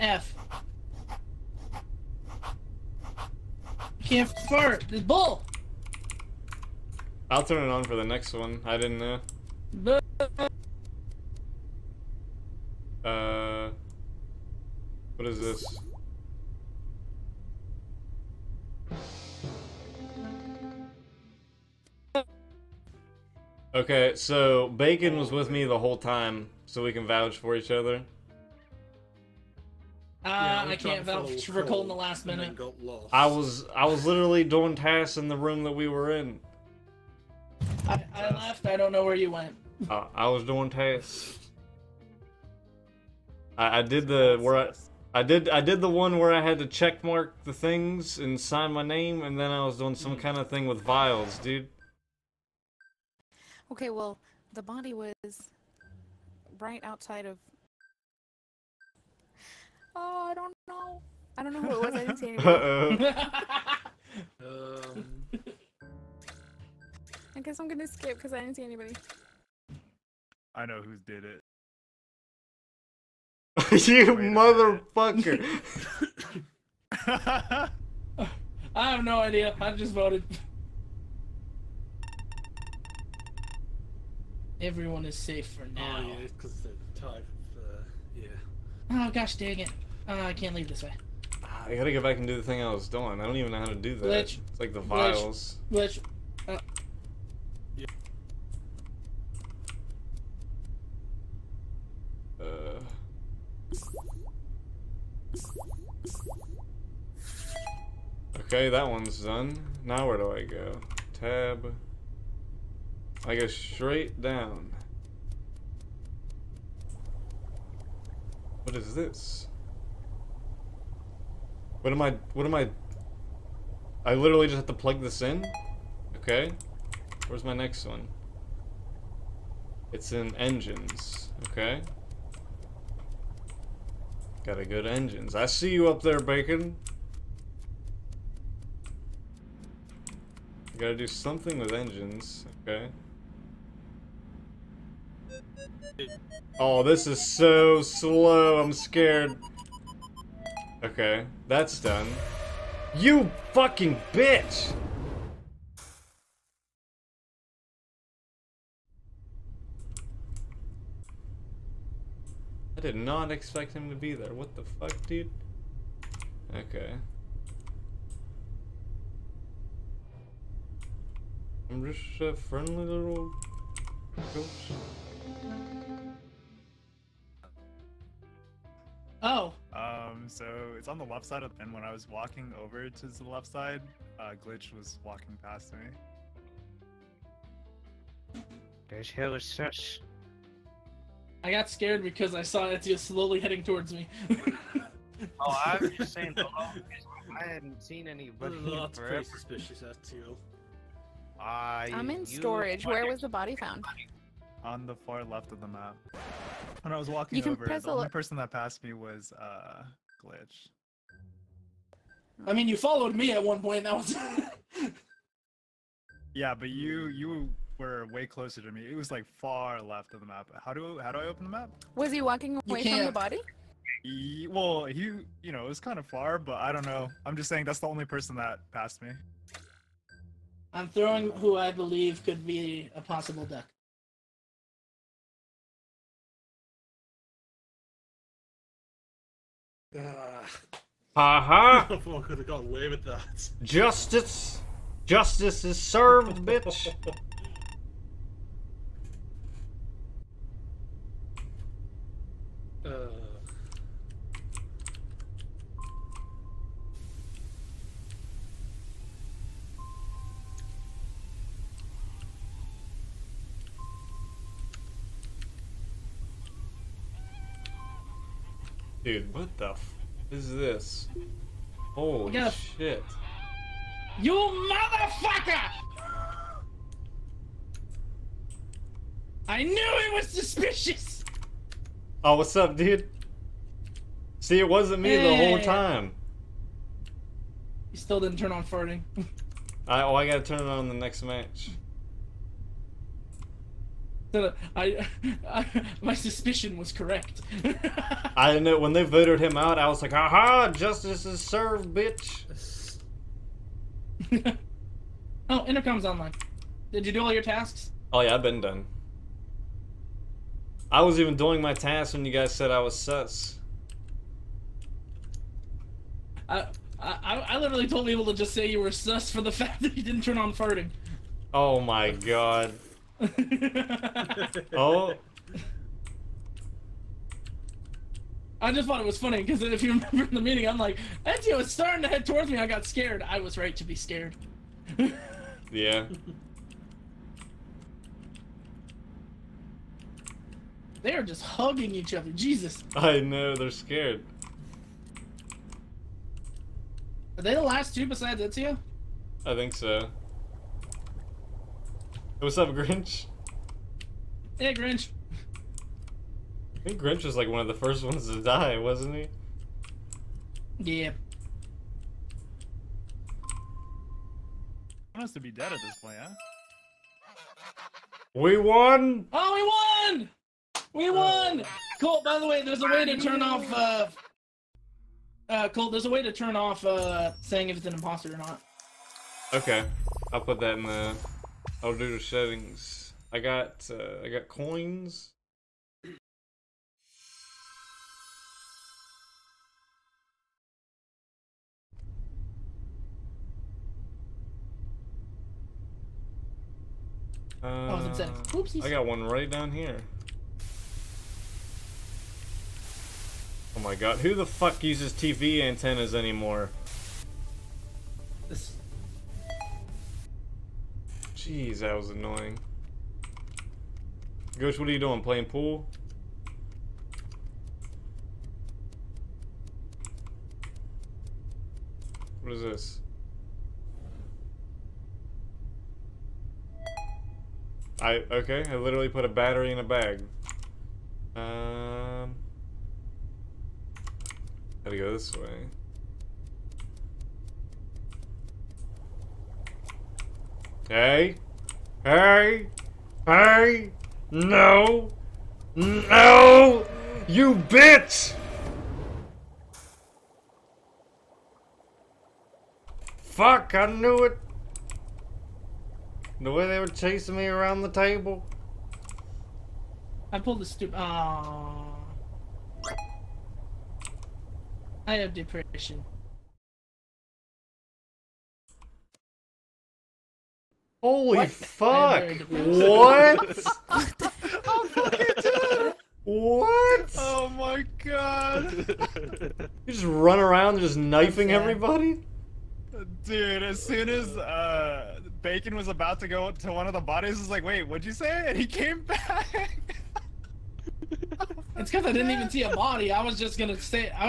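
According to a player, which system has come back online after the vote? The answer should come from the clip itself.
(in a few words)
Intercom.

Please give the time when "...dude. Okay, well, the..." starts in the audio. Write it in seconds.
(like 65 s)
51 s.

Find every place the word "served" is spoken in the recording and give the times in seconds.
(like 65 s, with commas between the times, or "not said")
245 s, 301 s.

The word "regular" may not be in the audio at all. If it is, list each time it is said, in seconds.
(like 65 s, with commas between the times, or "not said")
not said.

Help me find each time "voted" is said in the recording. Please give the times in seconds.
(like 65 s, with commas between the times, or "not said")
79 s, 299 s.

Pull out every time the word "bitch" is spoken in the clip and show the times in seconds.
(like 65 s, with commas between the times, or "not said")
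154 s, 246 s, 301 s, 447 s.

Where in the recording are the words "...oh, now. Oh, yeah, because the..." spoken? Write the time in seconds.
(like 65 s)
85 s.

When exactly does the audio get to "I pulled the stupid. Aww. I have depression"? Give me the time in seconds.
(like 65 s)
460 s.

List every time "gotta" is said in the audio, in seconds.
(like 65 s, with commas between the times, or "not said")
91 s, 134 s, 140 s, 290 s, 434 s.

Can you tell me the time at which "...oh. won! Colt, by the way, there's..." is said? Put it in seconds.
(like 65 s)
371 s.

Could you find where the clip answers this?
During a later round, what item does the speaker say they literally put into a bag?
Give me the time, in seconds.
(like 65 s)
429 s.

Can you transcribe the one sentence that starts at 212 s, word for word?
I mean, you followed me at one point.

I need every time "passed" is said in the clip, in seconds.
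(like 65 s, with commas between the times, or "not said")
208 s, 228 s.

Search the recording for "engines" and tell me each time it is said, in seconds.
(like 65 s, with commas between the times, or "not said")
130 s, 134 s, 141 s.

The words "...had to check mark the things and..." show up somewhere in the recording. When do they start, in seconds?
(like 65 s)
46 s.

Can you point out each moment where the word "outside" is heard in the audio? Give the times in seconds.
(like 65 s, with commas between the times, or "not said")
56 s.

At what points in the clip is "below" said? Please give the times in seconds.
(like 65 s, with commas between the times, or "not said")
not said.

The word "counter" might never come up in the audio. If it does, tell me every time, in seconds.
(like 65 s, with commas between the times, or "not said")
not said.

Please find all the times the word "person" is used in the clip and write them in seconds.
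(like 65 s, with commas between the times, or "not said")
208 s, 228 s.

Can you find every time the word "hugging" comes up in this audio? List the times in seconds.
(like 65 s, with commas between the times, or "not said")
341 s.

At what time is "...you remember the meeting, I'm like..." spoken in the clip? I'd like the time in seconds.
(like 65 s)
329 s.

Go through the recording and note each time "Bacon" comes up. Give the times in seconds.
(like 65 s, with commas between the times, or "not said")
24 s, 136 s, 485 s.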